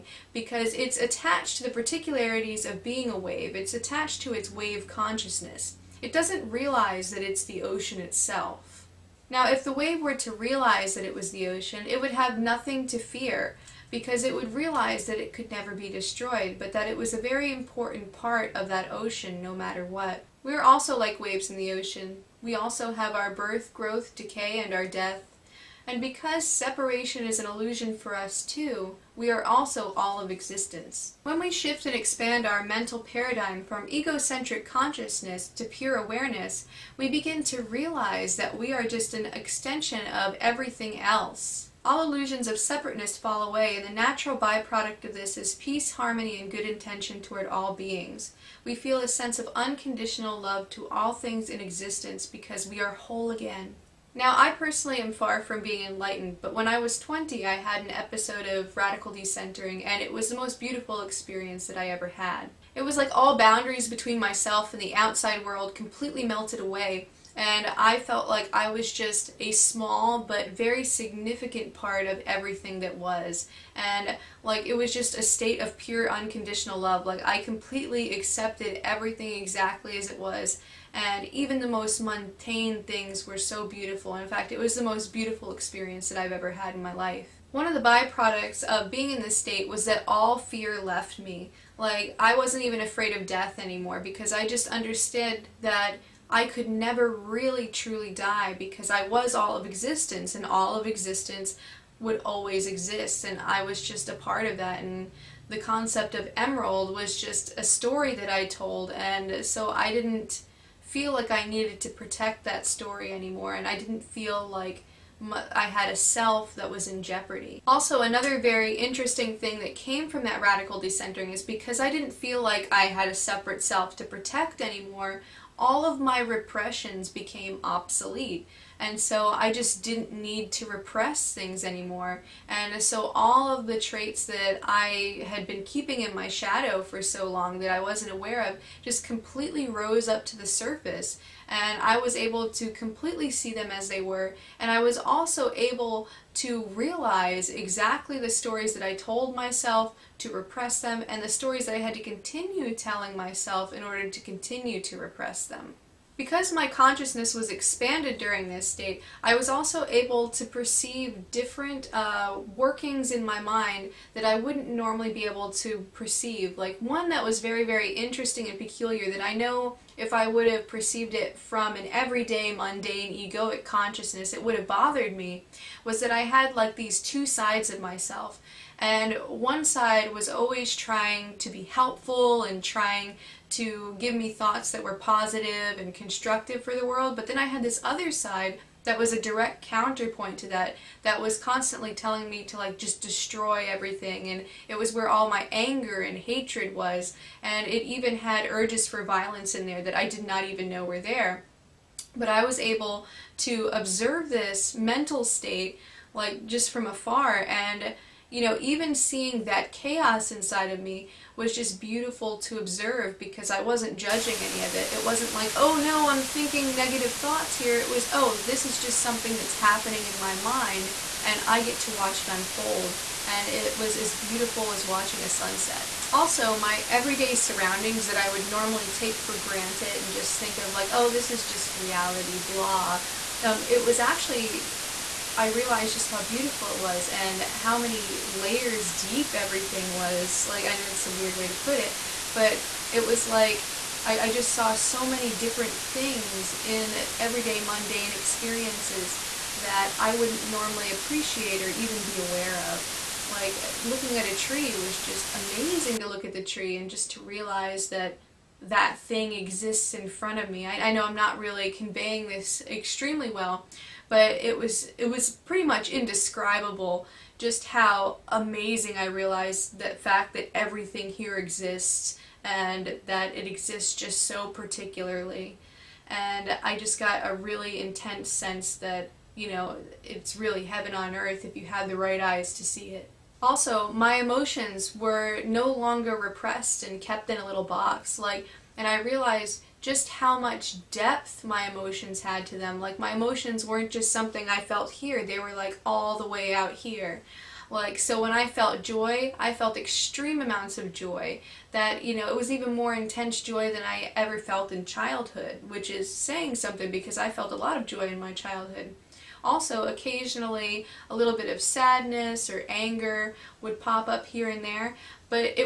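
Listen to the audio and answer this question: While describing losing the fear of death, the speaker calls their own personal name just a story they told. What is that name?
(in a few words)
Emerald.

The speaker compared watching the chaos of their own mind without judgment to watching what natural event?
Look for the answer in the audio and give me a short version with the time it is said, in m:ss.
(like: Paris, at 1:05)
a sunset, at 3:45.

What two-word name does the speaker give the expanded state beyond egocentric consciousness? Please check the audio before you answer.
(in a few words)
pure awareness.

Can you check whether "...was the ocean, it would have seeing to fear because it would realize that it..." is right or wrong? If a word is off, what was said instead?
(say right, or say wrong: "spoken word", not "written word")
wrong: "nothing", not "seeing".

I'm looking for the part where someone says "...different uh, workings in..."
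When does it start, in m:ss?
2:41.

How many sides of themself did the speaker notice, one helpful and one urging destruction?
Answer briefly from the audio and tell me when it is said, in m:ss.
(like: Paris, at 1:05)
2, at 2:57.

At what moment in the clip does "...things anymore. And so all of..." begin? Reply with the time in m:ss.
2:11.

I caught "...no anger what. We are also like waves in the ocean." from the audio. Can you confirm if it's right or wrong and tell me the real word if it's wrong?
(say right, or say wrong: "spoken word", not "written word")
wrong: "matter", not "anger".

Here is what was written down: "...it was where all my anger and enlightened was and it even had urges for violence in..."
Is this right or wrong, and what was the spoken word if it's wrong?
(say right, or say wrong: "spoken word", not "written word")
wrong: "hatred", not "enlightened".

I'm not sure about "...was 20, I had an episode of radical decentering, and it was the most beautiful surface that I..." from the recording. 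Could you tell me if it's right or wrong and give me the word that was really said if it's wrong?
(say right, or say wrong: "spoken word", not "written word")
wrong: "experience", not "surface".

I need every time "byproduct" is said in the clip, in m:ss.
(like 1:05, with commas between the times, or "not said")
0:44, 1:27.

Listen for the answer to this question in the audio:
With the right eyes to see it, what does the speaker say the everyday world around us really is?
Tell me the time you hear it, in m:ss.
4:40.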